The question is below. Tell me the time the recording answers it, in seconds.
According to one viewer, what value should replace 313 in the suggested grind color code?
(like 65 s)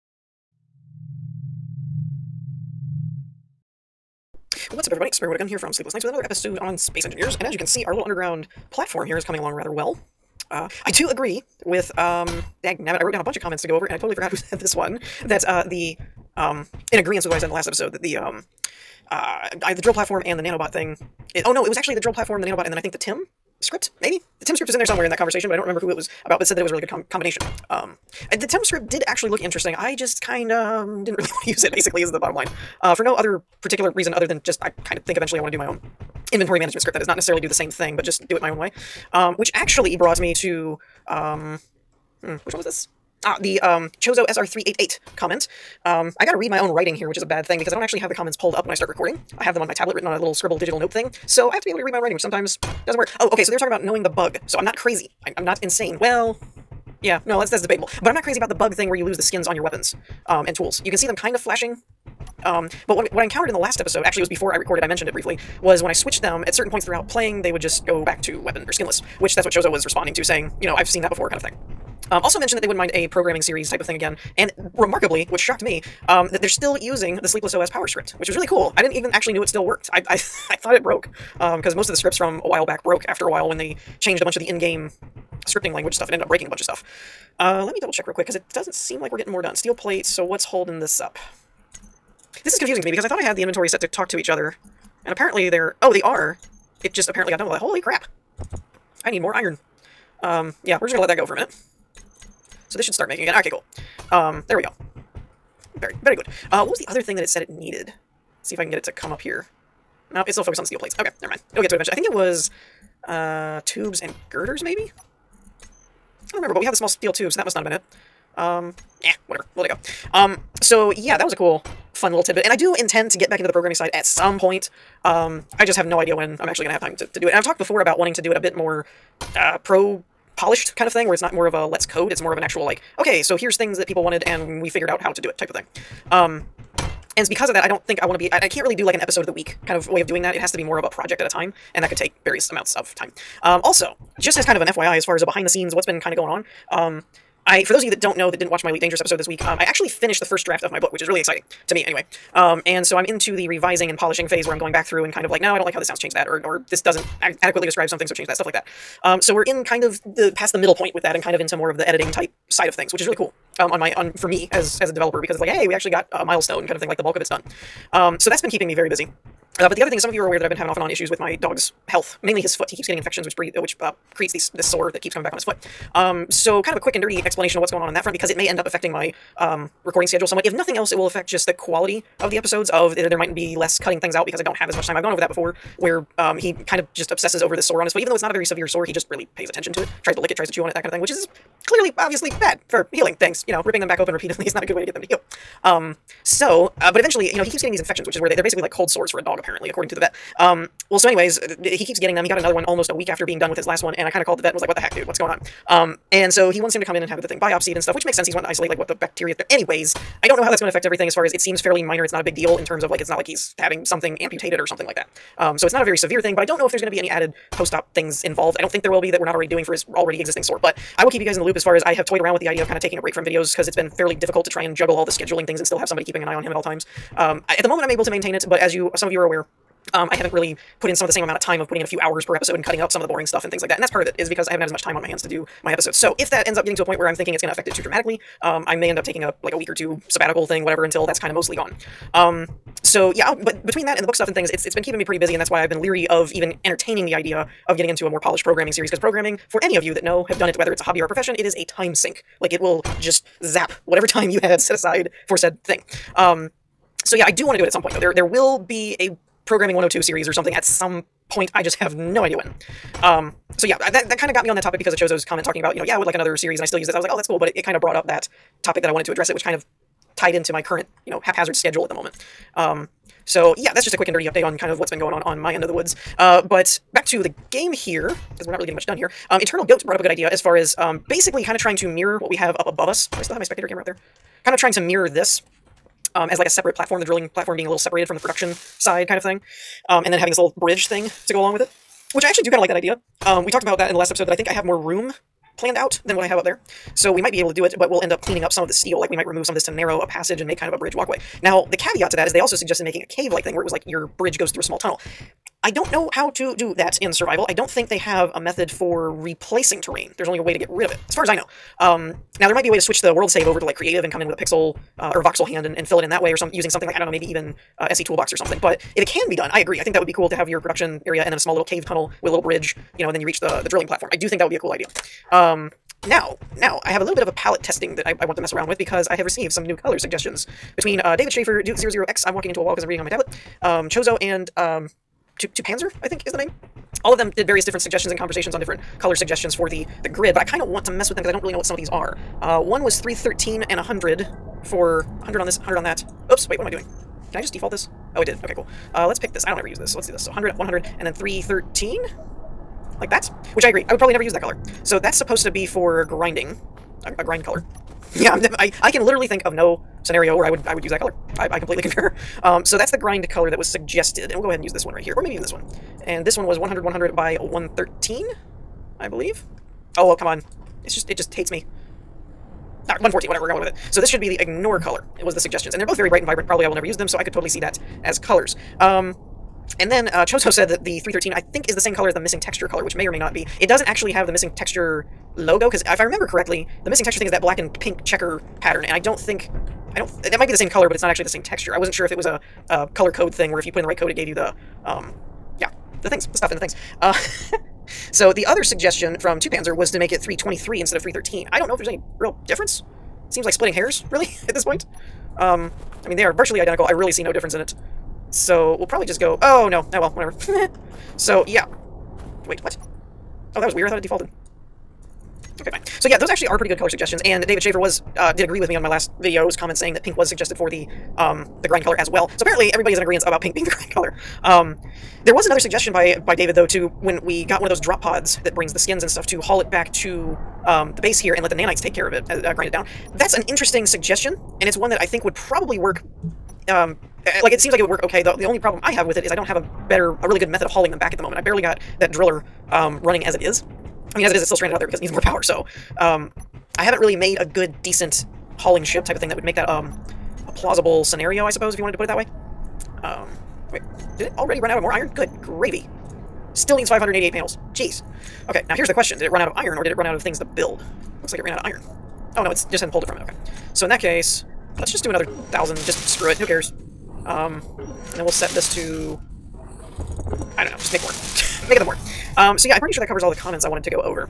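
400 s.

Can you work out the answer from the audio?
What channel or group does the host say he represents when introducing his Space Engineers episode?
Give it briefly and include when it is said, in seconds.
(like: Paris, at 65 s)
Sleepless Knights, at 5 s.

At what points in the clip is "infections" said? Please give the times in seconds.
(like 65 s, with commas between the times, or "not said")
172 s, 197 s.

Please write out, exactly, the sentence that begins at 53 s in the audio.
Oh, okay, so they were talking about knowing the bug.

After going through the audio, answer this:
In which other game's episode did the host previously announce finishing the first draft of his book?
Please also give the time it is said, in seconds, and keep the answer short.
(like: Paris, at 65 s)
Elite Dangerous, at 148 s.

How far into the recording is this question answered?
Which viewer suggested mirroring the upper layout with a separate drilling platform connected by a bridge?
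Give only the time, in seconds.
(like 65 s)
279 s.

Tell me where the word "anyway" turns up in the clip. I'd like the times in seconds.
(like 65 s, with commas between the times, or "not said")
151 s, 201 s, 209 s.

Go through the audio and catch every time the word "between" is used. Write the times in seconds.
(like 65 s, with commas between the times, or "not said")
243 s, 330 s.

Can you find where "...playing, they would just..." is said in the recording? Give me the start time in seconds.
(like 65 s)
67 s.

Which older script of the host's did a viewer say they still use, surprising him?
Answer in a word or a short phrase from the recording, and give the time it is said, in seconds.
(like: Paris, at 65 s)
Sleepless OS power script, at 77 s.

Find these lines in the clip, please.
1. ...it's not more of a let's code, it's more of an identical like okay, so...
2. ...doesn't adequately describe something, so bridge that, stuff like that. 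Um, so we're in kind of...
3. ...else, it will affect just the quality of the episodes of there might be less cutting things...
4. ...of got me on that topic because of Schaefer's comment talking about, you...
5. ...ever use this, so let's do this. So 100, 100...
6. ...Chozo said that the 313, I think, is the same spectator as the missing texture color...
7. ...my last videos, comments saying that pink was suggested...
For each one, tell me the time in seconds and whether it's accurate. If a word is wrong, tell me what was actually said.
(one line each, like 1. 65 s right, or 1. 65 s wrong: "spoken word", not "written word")
1. 131 s wrong: "actual", not "identical"
2. 156 s wrong: "change", not "bridge"
3. 180 s right
4. 264 s wrong: "Chozo", not "Schaefer"
5. 349 s right
6. 380 s wrong: "color", not "spectator"
7. 418 s right.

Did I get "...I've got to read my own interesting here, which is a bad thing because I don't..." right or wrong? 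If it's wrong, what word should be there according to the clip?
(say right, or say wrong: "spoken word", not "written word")
wrong: "writing", not "interesting".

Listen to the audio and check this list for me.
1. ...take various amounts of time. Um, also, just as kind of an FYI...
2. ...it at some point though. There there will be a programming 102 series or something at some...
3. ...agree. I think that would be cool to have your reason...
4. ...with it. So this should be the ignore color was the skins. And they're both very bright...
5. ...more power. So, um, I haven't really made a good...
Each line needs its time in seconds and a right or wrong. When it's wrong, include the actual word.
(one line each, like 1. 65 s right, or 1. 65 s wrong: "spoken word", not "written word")
1. 141 s right
2. 257 s right
3. 319 s wrong: "production", not "reason"
4. 373 s wrong: "suggestions", not "skins"
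5. 445 s right.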